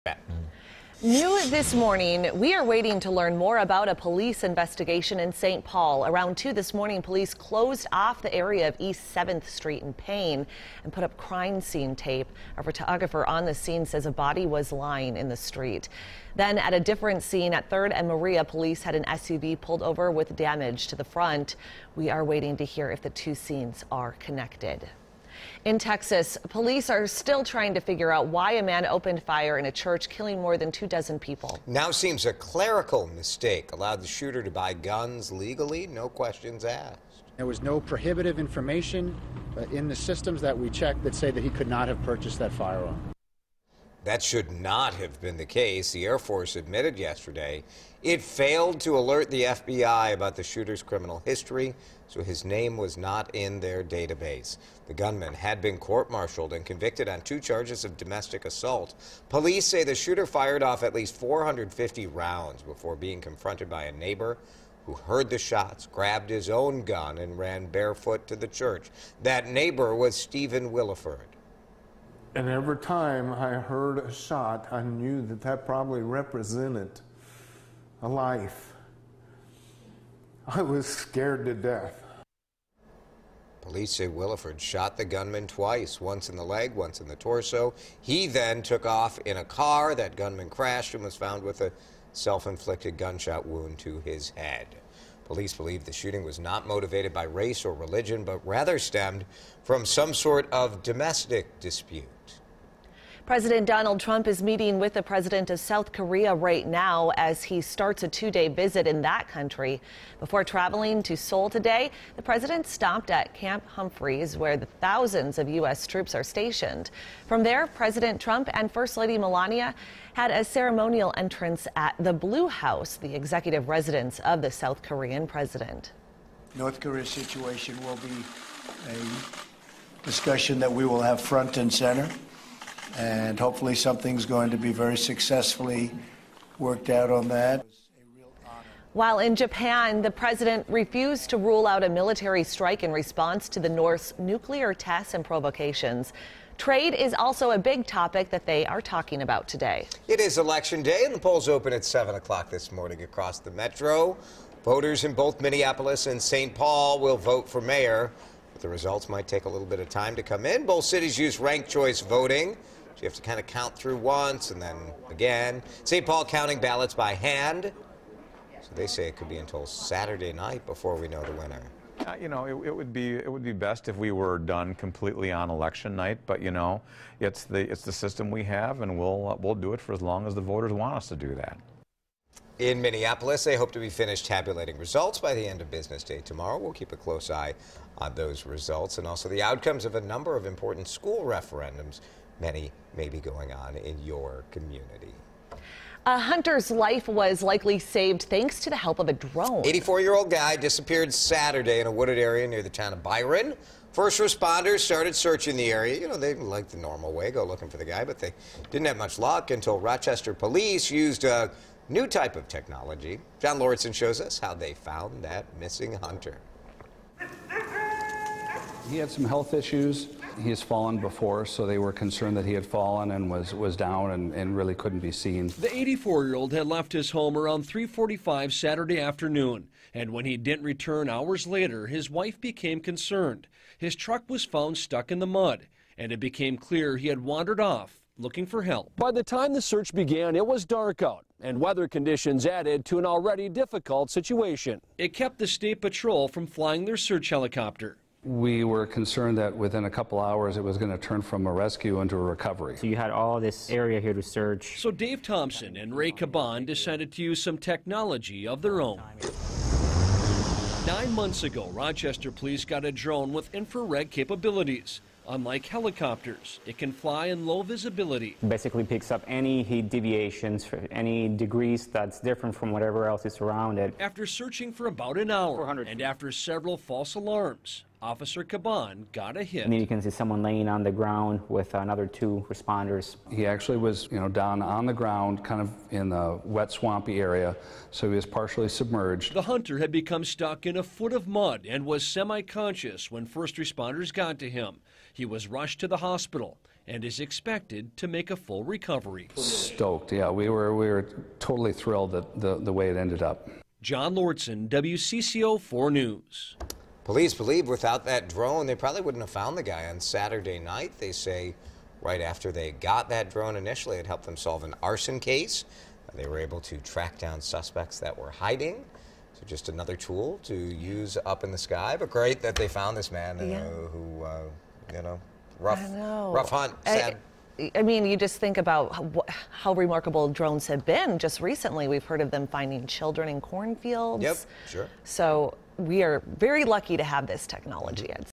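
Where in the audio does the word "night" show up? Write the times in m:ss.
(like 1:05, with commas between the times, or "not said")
2:50, 2:55, 5:10.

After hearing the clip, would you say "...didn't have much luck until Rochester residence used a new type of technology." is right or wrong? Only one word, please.
wrong.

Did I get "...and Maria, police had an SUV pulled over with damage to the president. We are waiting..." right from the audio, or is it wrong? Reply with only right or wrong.
wrong.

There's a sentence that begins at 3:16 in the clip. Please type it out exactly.
A hunter's life was likely saved thanks to the help of a drone.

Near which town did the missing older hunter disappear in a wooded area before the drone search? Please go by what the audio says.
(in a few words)
Byron.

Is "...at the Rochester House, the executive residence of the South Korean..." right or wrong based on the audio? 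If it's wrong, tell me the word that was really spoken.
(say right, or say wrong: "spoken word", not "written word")
wrong: "Blue", not "Rochester".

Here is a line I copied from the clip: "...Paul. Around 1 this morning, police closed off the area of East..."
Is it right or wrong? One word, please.
wrong.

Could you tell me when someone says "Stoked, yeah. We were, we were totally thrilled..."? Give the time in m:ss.
4:59.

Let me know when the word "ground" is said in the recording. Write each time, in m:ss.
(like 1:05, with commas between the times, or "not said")
4:40, 4:44.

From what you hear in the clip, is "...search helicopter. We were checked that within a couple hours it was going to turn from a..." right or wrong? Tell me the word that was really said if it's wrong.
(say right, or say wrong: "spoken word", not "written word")
wrong: "concerned", not "checked".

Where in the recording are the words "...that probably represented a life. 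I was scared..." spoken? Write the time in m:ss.
1:15.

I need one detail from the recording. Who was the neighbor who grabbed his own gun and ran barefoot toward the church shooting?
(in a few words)
Stephen Williford.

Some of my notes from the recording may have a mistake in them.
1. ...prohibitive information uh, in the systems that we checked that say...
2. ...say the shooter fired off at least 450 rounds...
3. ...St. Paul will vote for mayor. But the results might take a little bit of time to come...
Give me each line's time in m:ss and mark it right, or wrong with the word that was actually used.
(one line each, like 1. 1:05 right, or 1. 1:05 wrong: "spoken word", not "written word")
1. 0:37 right
2. 0:59 right
3. 2:36 right.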